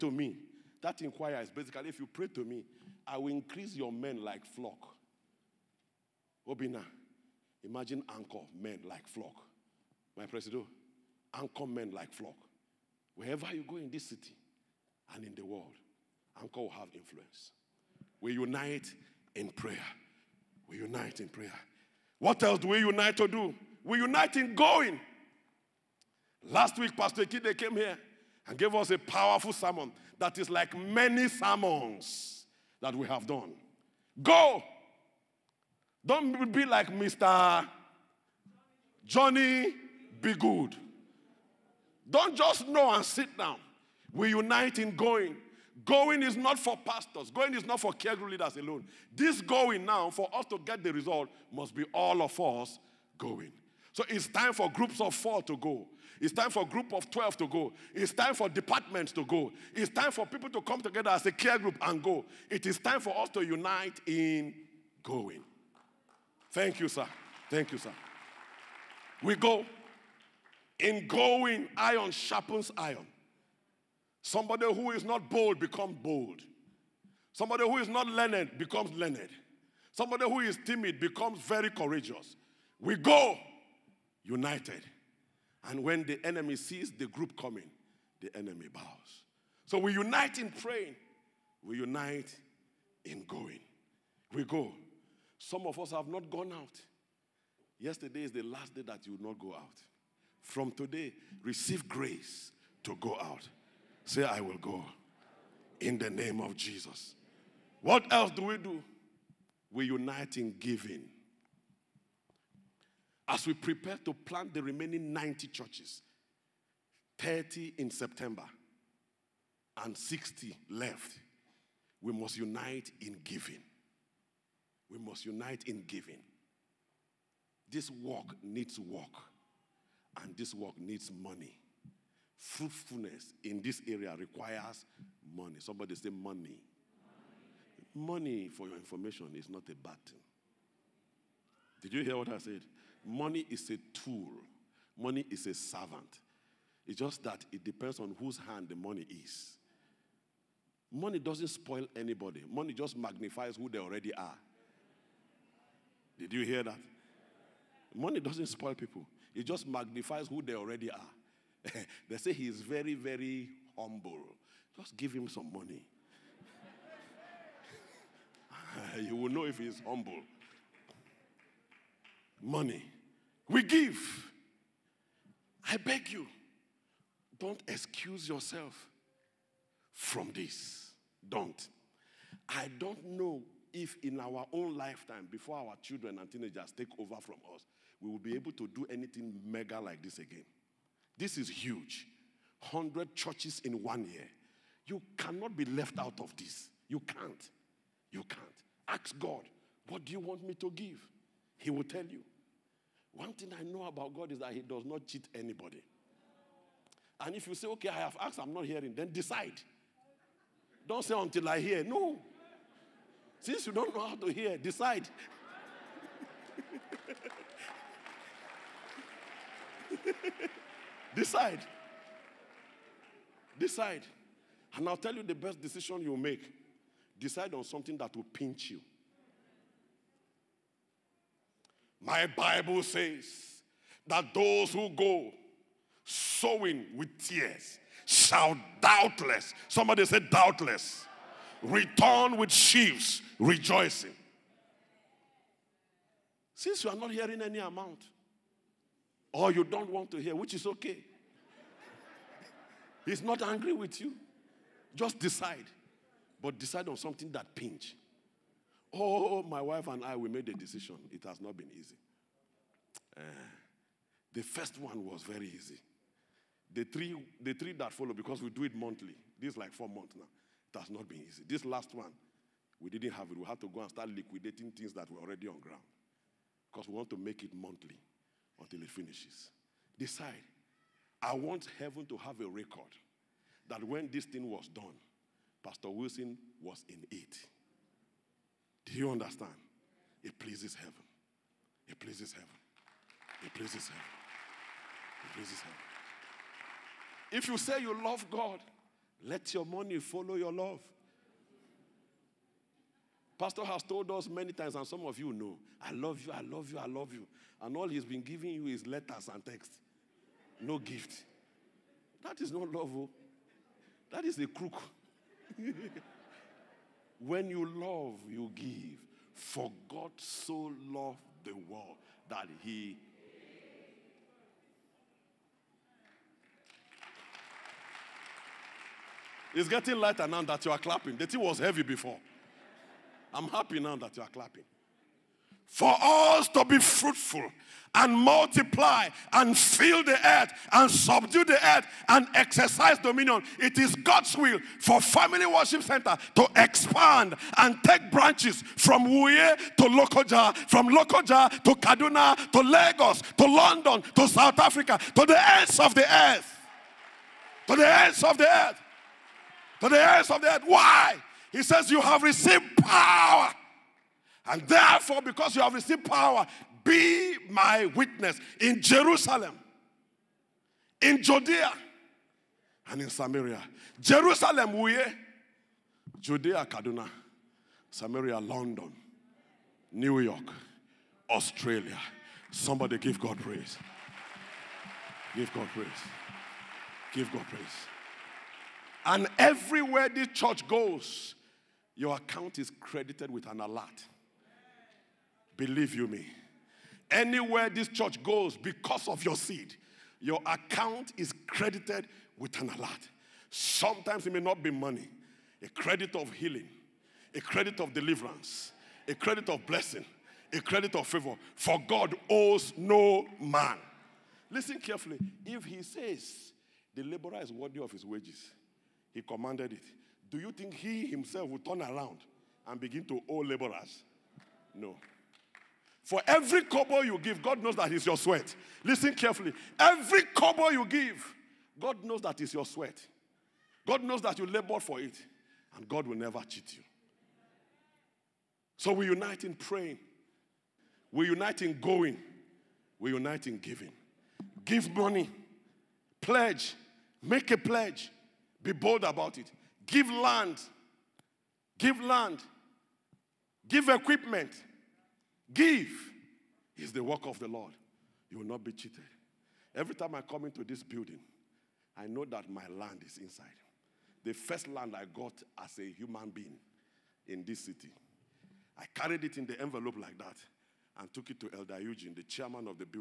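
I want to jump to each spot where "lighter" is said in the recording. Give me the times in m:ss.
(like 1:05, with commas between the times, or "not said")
5:29.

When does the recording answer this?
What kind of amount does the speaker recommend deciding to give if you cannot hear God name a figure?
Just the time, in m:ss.
3:47.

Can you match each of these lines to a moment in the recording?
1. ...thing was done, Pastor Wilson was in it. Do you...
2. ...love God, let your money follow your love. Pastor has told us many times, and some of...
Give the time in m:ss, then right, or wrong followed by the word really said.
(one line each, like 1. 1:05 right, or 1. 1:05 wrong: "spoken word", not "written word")
1. 4:44 right
2. 4:58 right.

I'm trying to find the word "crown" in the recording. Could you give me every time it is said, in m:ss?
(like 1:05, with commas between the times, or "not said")
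not said.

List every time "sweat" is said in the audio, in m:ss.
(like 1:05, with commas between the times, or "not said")
7:08, 7:12.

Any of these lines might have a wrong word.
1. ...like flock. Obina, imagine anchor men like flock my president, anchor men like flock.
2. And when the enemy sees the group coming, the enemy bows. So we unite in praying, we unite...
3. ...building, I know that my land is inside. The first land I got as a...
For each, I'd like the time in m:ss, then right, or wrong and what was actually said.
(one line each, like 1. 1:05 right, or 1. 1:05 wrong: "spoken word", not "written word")
1. 0:04 right
2. 1:25 right
3. 7:40 right.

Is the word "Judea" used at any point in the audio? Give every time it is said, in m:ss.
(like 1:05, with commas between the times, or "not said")
6:11, 6:16.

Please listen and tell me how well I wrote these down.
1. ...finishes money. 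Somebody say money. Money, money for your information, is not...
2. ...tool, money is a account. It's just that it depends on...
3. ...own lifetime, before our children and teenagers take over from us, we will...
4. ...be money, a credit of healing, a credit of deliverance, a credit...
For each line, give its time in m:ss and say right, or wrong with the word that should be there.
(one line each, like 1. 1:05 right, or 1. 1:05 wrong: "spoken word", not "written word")
1. 2:14 wrong: "requires", not "finishes"
2. 2:23 wrong: "servant", not "account"
3. 3:04 right
4. 6:44 right.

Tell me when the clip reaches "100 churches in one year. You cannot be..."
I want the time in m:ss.
3:12.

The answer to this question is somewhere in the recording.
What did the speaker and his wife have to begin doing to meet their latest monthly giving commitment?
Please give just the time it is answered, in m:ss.
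4:34.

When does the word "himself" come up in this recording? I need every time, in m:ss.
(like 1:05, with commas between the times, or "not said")
7:01.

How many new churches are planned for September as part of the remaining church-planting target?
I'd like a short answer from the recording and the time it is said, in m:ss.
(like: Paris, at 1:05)
30, at 1:57.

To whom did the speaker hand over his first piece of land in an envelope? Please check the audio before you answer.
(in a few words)
Elder Eugene.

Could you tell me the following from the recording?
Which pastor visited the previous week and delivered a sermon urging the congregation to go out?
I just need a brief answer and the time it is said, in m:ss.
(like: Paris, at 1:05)
Pastor Kide, at 0:26.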